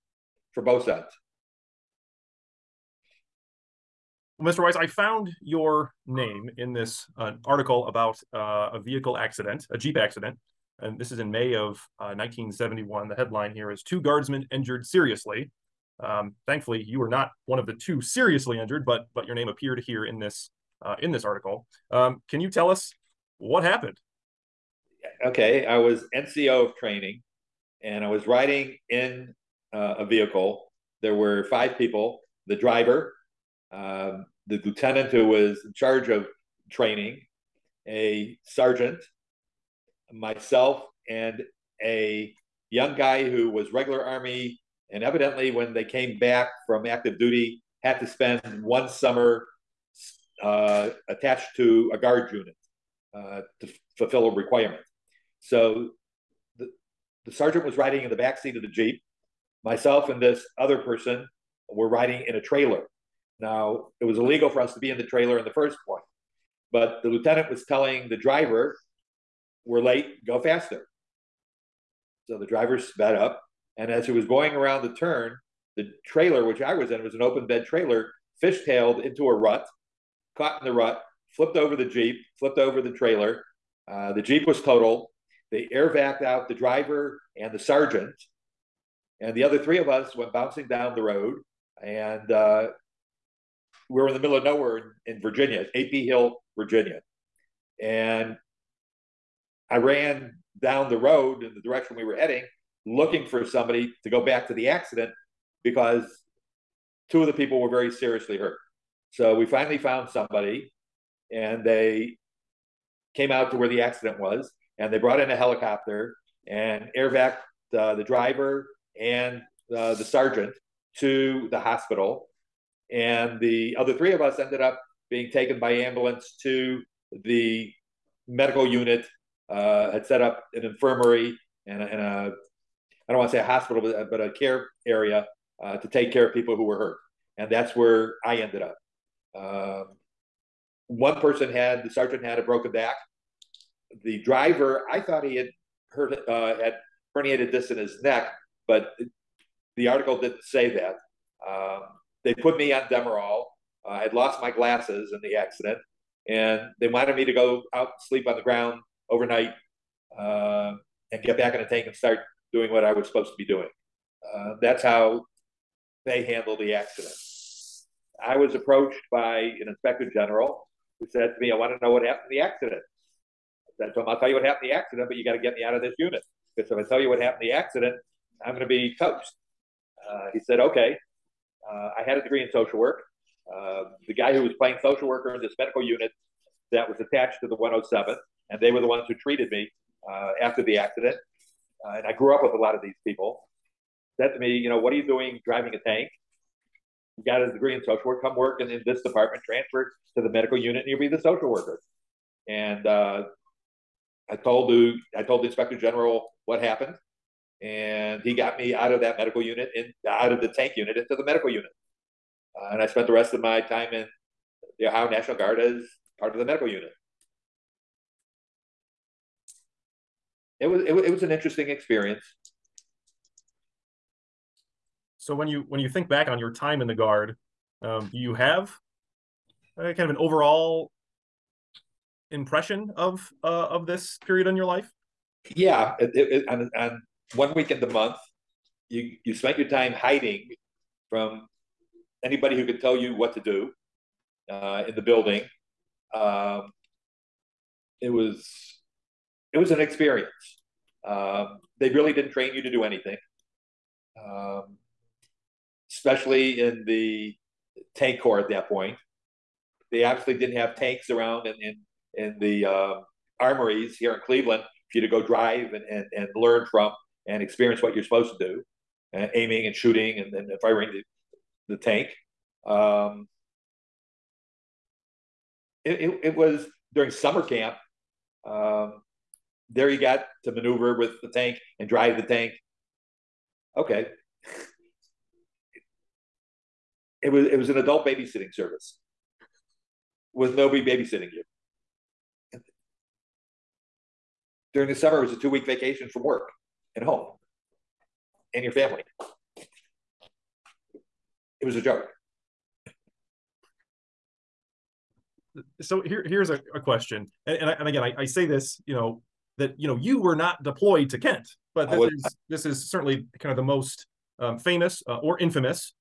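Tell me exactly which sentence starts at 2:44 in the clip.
Uh, that's how they handled the accident.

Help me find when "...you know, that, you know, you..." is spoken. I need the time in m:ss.
5:08.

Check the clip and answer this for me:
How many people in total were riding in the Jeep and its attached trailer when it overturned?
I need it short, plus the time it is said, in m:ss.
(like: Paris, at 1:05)
5, at 0:31.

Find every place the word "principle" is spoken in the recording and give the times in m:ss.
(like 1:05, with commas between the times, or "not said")
not said.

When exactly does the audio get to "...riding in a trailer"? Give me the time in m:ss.
1:01.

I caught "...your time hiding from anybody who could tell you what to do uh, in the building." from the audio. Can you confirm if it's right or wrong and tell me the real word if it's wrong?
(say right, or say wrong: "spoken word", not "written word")
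right.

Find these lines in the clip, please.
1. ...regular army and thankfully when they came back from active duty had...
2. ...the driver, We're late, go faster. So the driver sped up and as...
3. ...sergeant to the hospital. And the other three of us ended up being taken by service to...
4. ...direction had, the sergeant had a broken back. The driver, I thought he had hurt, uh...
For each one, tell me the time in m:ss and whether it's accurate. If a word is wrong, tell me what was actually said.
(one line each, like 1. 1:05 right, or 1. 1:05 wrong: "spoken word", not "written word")
1. 0:43 wrong: "evidently", not "thankfully"
2. 1:08 right
3. 2:00 wrong: "ambulance", not "service"
4. 2:21 wrong: "person", not "direction".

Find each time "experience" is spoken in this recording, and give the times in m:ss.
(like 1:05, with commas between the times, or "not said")
3:41, 4:09, 4:27.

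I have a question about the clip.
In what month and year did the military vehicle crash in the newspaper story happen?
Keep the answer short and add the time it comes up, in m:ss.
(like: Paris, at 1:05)
May 1971, at 0:11.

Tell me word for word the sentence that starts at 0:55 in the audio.
So the, the sergeant was riding in the back seat of the Jeep.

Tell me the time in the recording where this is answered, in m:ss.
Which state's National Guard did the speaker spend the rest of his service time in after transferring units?
3:34.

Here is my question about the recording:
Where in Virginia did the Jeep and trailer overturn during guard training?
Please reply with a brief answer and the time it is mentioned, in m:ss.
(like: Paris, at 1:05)
AP Hill, Virginia, at 1:35.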